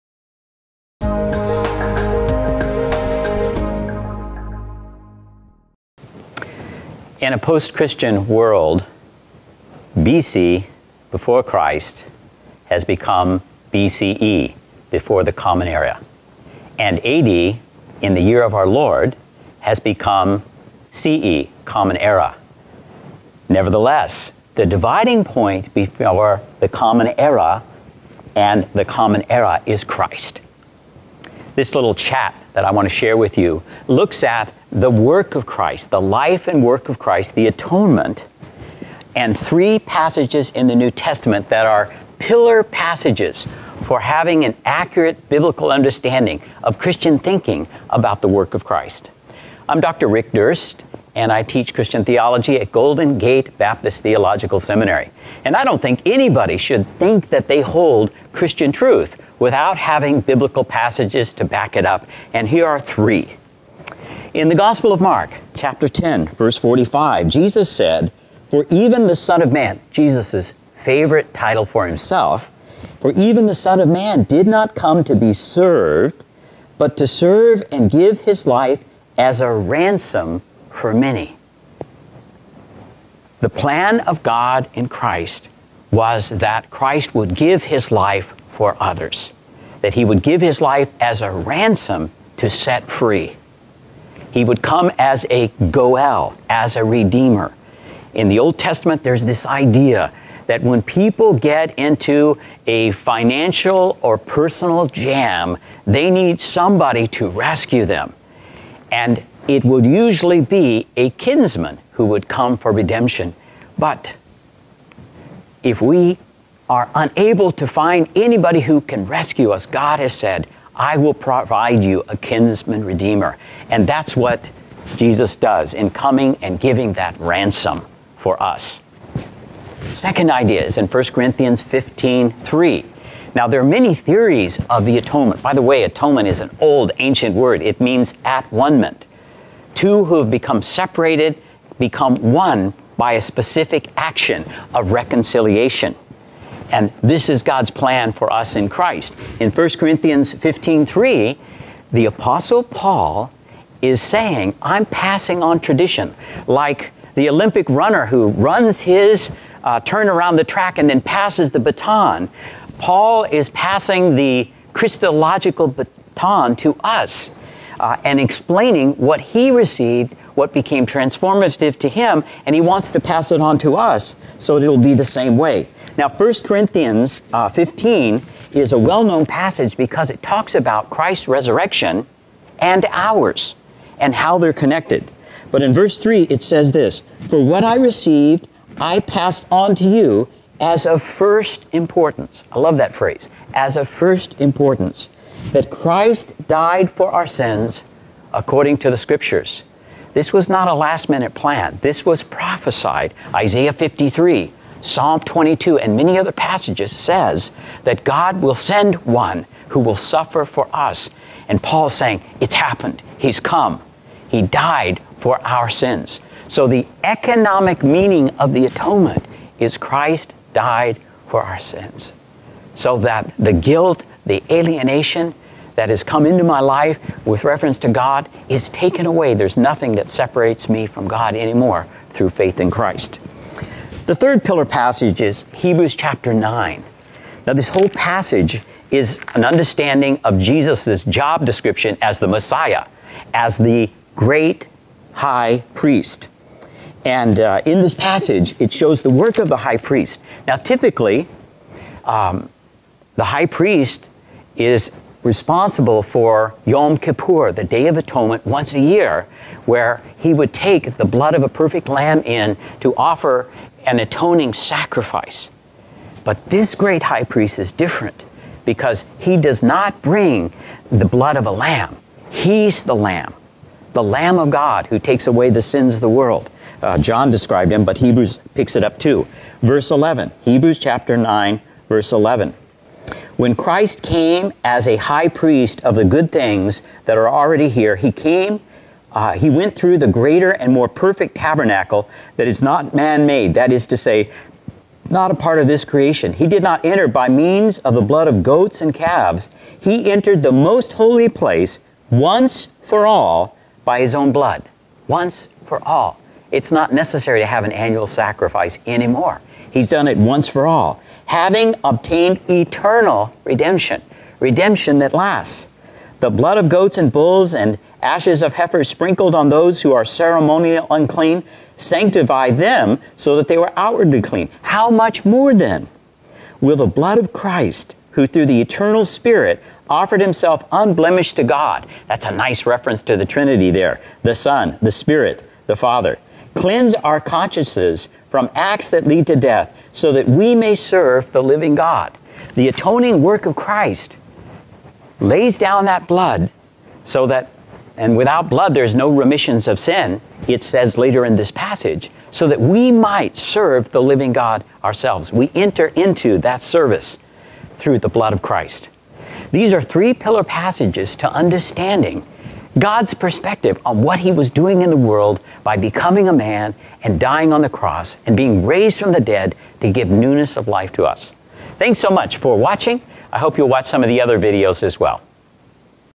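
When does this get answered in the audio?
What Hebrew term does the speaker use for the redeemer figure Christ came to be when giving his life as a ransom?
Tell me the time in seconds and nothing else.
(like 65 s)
95 s.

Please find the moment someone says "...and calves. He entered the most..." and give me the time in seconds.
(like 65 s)
298 s.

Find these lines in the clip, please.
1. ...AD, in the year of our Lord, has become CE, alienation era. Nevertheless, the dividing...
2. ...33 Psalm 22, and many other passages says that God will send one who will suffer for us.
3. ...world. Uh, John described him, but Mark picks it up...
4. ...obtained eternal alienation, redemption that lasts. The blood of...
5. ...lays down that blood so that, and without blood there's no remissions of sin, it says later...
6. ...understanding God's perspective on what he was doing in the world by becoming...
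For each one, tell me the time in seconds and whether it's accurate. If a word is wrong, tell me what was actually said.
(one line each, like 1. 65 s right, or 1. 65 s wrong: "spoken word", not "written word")
1. 17 s wrong: "common", not "alienation"
2. 203 s wrong: "53", not "33"
3. 276 s wrong: "Hebrews", not "Mark"
4. 311 s wrong: "redemption", not "alienation"
5. 345 s right
6. 361 s right.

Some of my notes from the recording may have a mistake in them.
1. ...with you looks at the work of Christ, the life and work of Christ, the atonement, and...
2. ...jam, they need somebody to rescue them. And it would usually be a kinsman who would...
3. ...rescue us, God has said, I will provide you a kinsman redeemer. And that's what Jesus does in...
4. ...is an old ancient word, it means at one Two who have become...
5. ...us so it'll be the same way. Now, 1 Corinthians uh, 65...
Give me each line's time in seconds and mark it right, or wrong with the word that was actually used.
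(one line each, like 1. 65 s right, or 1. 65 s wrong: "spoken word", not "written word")
1. 33 s right
2. 104 s right
3. 119 s right
4. 136 s right
5. 173 s wrong: "15", not "65".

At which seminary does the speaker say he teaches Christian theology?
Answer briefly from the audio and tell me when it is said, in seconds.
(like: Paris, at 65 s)
Golden Gate Baptist Theological Seminary, at 52 s.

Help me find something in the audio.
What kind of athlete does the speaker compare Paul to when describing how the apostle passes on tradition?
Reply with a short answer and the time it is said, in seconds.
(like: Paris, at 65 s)
Olympic runner, at 157 s.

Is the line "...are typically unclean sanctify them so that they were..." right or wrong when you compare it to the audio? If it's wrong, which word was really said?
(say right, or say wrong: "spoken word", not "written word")
wrong: "ceremonially", not "typically".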